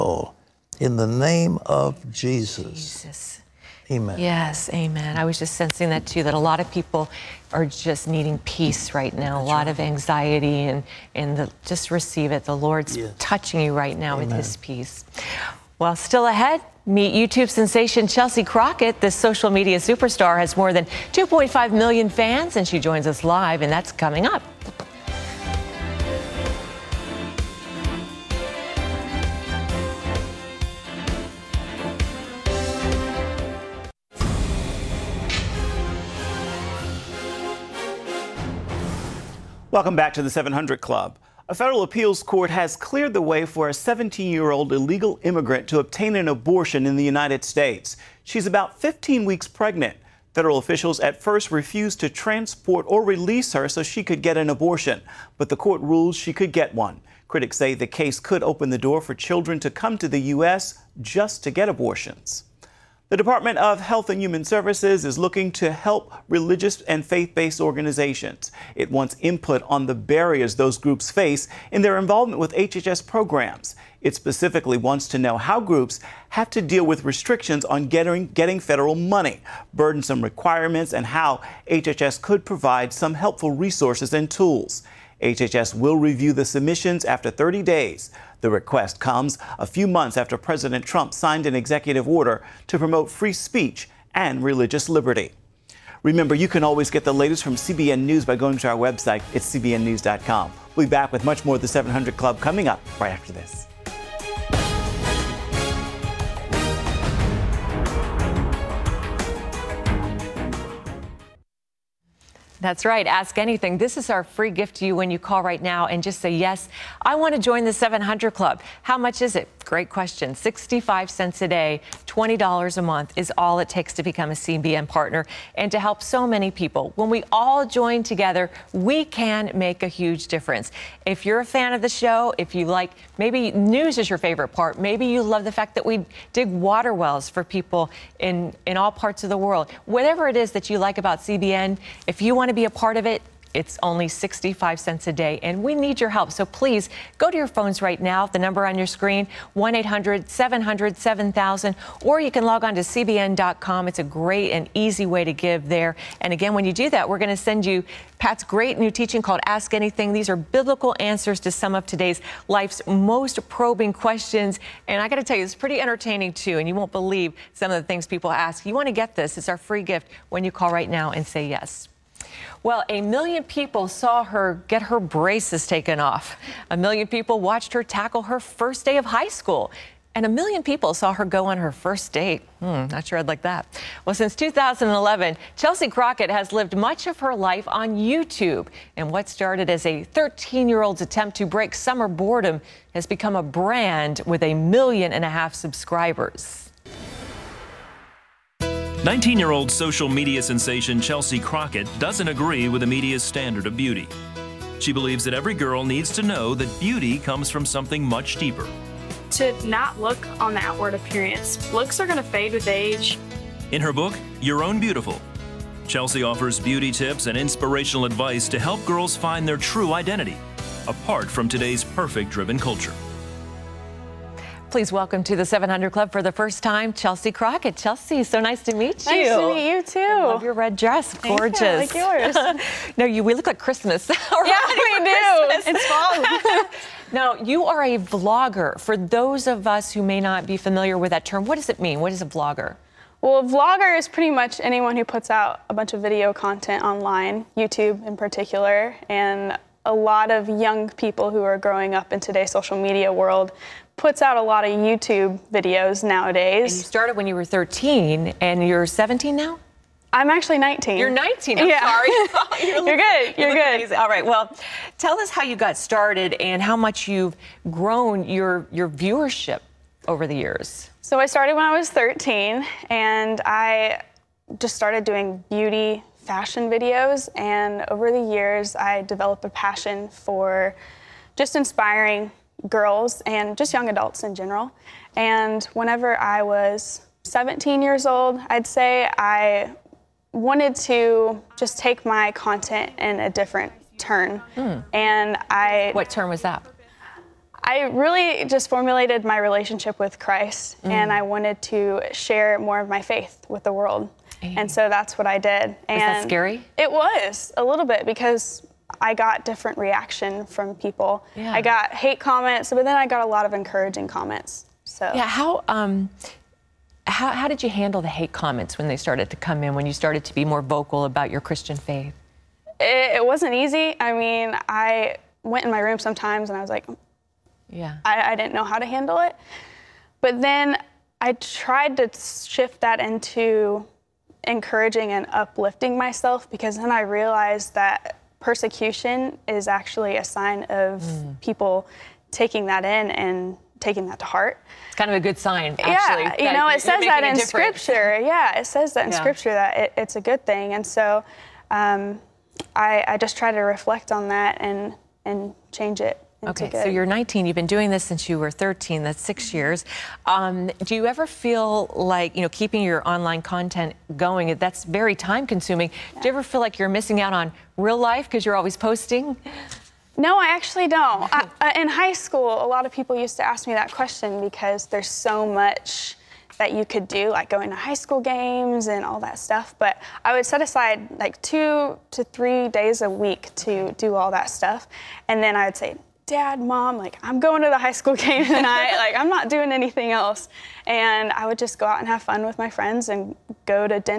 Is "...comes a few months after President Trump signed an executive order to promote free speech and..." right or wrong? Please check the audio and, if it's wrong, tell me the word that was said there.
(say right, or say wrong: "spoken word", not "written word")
right.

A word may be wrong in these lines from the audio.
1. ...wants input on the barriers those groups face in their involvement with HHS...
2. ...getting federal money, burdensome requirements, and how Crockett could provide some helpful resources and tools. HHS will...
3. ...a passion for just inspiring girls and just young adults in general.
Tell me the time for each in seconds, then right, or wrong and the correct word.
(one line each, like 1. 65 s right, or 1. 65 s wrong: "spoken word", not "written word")
1. 68 s right
2. 78 s wrong: "HHS", not "Crockett"
3. 279 s right.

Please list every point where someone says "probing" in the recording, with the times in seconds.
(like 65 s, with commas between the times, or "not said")
163 s.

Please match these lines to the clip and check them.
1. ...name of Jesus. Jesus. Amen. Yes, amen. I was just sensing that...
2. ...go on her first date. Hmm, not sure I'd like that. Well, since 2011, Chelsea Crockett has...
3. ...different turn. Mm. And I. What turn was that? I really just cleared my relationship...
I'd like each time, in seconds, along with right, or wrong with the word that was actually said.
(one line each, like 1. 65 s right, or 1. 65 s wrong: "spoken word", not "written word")
1. 1 s right
2. 181 s right
3. 293 s wrong: "formulated", not "cleared".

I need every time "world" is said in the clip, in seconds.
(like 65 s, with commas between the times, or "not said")
139 s, 253 s, 303 s.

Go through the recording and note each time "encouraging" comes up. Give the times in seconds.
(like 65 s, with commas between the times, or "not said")
313 s, 334 s.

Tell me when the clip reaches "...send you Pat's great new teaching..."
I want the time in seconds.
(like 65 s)
157 s.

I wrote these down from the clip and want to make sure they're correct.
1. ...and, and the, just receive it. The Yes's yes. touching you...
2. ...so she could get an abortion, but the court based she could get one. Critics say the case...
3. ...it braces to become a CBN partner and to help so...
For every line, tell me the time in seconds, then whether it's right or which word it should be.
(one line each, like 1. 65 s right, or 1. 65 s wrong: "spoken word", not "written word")
1. 10 s wrong: "Lord", not "Yes"
2. 53 s wrong: "ruled", not "based"
3. 123 s wrong: "takes", not "braces".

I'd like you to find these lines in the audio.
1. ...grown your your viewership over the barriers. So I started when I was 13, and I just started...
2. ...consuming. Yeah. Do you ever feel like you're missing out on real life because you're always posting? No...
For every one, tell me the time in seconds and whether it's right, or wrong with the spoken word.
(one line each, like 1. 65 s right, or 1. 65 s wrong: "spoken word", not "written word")
1. 267 s wrong: "years", not "barriers"
2. 365 s right.